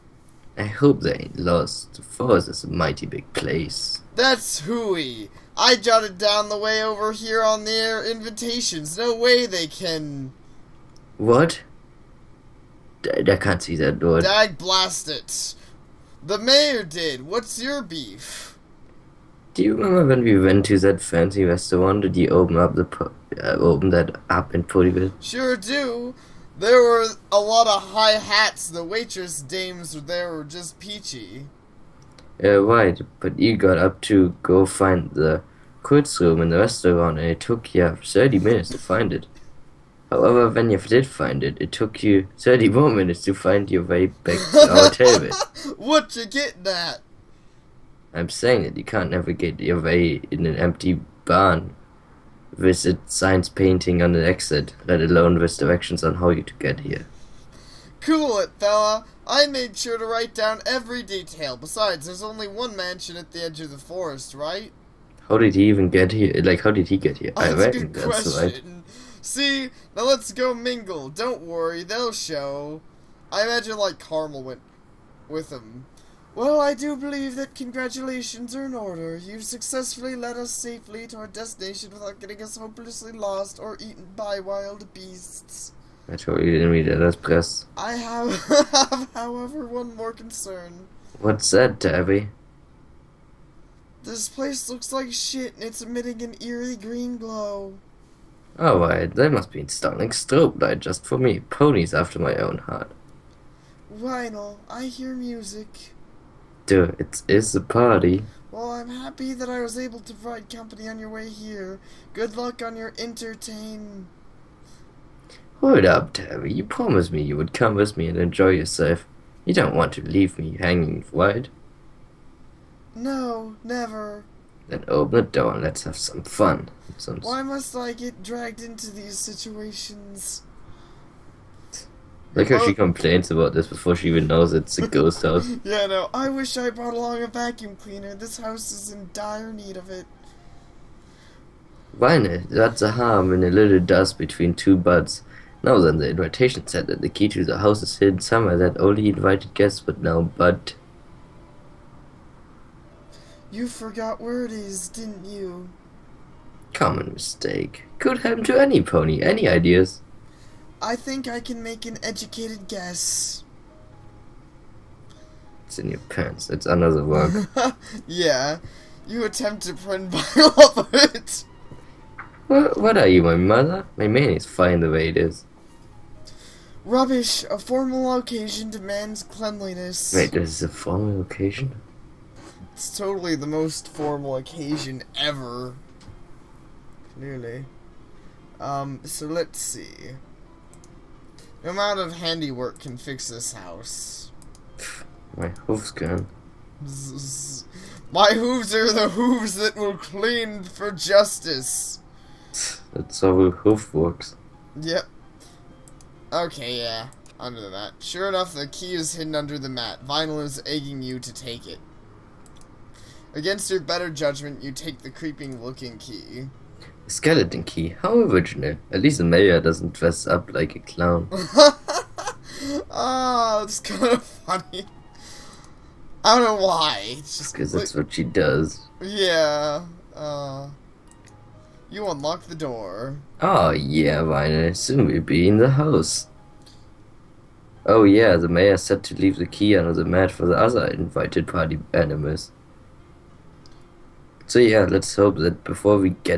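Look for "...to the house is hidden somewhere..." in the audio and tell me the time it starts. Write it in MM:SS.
02:27.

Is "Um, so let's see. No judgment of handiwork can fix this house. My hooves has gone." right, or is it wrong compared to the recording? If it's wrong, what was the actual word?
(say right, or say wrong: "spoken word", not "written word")
wrong: "amount", not "judgment".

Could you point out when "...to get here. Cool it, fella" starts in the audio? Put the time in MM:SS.
00:56.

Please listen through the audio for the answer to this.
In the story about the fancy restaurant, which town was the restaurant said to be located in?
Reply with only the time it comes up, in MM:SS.
00:24.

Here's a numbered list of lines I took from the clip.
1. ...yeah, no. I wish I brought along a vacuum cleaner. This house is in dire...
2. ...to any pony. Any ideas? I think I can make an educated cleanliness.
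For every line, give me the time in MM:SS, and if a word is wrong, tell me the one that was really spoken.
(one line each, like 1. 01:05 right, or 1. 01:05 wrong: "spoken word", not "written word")
1. 02:15 right
2. 02:38 wrong: "guess", not "cleanliness".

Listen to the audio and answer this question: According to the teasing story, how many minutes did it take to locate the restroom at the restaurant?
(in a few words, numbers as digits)
30.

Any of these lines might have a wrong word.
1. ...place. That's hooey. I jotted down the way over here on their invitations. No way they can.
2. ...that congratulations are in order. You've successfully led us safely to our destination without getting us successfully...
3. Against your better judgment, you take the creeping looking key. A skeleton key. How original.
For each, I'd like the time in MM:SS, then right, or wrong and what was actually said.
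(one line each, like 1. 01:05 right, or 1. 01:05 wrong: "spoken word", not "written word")
1. 00:03 right
2. 01:17 wrong: "hopelessly", not "successfully"
3. 03:33 right.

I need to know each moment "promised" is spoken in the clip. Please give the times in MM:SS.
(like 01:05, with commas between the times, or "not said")
01:56.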